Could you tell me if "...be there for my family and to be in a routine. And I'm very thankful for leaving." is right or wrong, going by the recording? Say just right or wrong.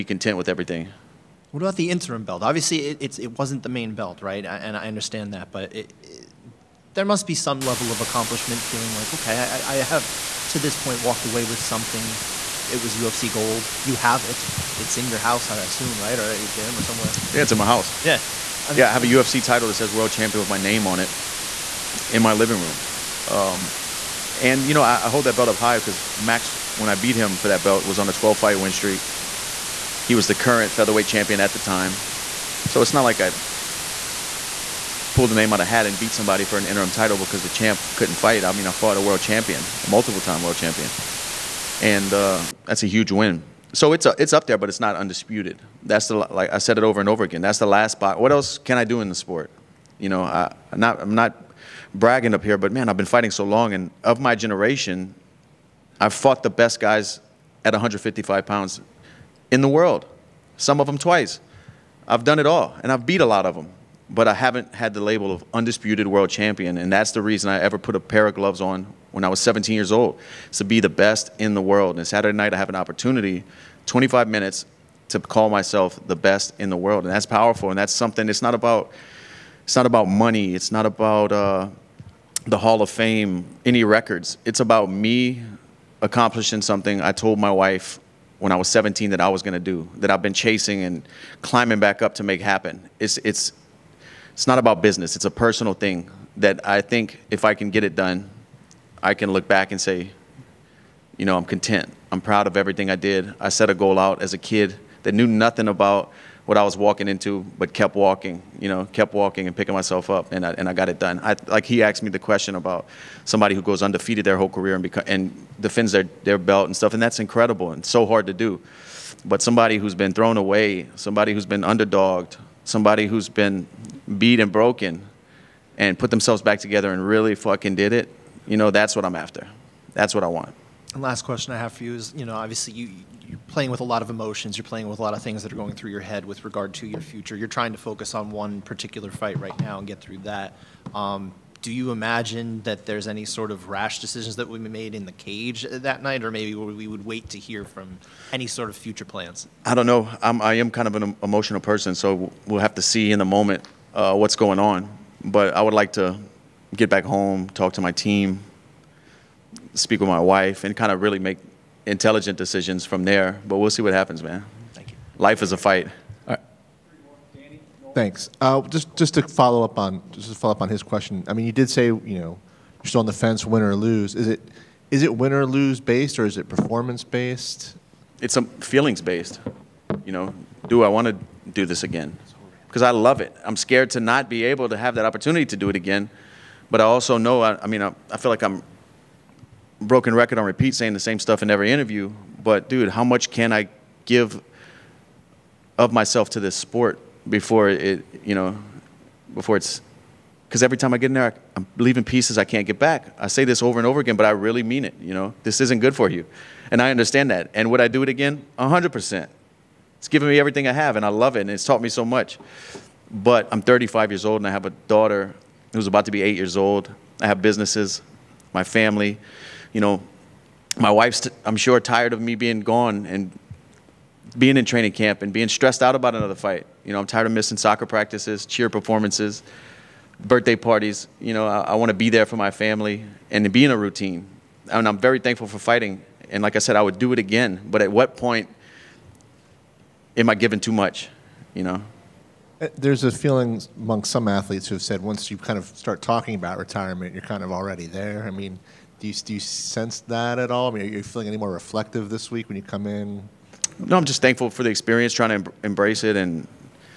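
wrong.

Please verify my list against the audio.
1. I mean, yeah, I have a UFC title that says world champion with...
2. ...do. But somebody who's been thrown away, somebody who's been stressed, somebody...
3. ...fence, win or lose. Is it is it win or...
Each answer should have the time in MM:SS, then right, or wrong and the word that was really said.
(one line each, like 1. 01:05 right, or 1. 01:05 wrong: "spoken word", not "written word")
1. 00:18 right
2. 01:58 wrong: "underdogged", not "stressed"
3. 02:53 right.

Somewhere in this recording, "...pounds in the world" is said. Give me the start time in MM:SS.
00:58.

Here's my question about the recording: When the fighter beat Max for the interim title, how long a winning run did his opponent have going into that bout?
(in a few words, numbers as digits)
12 fights.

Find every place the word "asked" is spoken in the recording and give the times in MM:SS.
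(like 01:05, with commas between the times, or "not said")
01:51.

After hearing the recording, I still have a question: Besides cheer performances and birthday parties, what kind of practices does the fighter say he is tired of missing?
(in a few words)
Soccer practices.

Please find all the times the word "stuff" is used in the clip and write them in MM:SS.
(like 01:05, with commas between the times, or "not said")
01:56, 03:11.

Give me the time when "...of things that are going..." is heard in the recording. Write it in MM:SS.
02:15.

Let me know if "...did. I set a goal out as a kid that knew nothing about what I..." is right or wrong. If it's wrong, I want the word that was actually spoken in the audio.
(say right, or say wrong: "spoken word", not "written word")
right.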